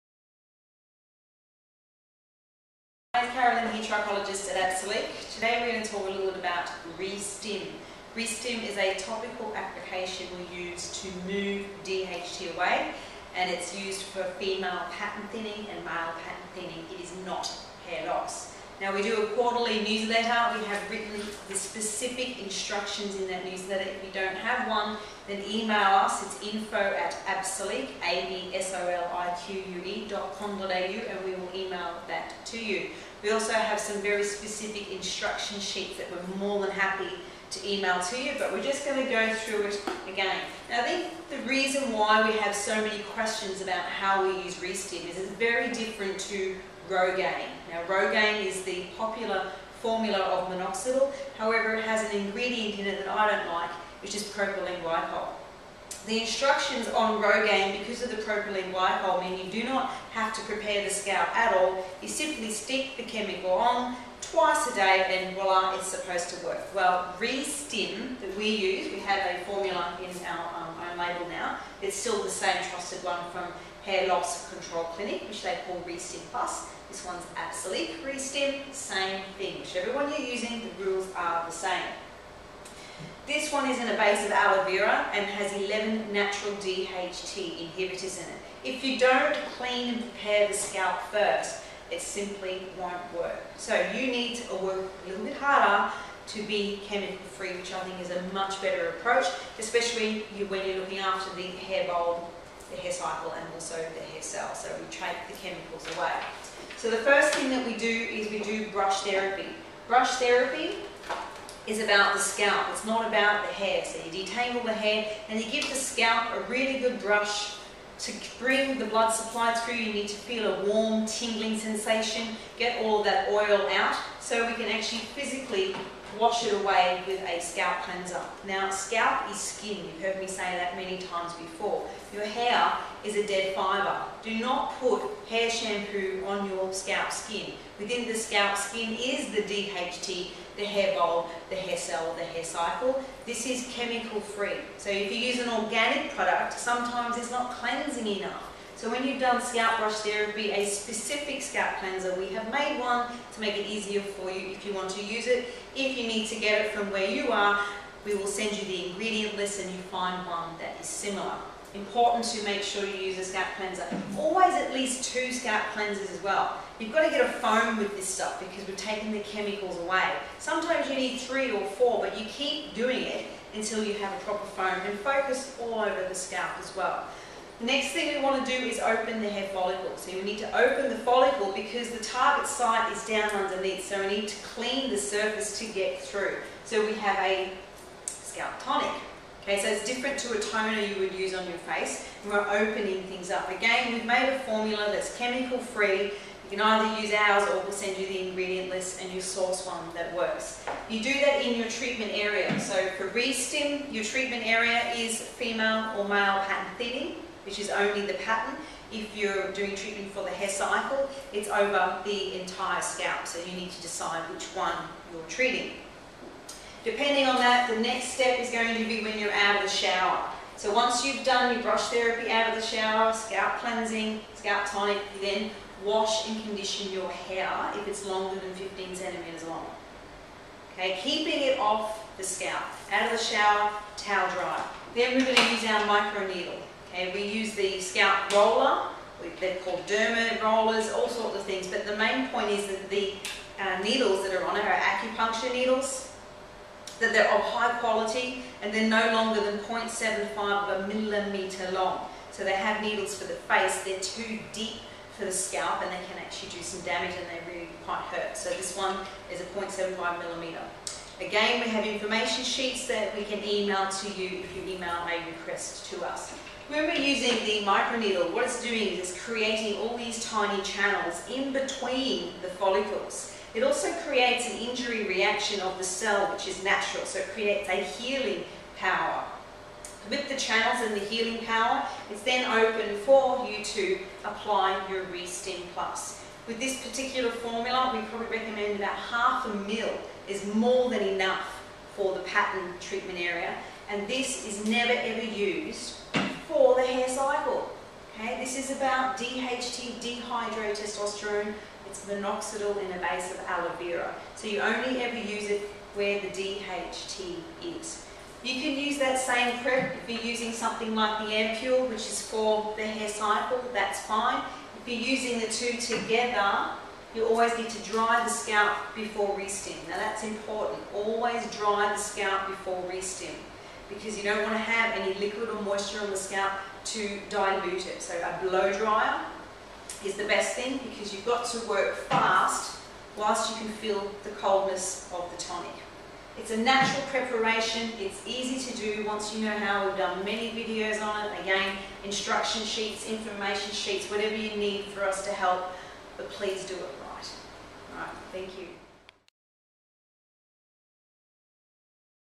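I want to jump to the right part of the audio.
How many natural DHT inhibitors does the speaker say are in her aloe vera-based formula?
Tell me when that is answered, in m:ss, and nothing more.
1:25.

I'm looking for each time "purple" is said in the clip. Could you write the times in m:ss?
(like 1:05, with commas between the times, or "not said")
not said.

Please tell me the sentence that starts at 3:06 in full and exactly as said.
So we have a scalp tonic.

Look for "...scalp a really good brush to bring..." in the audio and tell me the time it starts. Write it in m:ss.
1:55.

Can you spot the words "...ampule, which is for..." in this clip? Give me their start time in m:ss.
5:11.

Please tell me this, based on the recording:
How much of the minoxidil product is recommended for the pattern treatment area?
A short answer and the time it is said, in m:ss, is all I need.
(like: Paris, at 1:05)
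half a mil, at 4:48.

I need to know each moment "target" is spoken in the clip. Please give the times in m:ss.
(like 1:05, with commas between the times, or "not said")
3:02.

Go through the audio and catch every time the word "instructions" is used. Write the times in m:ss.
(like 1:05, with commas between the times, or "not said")
0:22, 0:34, 0:56, 5:42.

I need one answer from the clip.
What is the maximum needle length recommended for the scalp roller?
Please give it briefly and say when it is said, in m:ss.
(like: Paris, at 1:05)
0.75 mm, at 4:09.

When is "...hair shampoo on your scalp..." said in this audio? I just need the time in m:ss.
2:15.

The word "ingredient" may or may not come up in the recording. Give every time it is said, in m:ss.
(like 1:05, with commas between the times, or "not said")
0:52, 2:38, 3:18.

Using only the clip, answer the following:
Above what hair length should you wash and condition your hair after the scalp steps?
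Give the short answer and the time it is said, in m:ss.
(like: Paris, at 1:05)
15 centimetres, at 3:48.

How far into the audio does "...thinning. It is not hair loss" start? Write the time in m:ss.
0:16.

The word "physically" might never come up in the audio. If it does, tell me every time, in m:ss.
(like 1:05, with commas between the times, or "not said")
2:05.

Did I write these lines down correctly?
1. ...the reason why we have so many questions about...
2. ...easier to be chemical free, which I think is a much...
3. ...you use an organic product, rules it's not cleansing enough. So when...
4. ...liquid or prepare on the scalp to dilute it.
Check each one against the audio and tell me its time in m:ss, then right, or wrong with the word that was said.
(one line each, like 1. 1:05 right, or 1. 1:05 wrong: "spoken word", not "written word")
1. 0:41 right
2. 1:35 wrong: "harder", not "easier"
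3. 2:25 wrong: "sometimes", not "rules"
4. 5:25 wrong: "moisture", not "prepare".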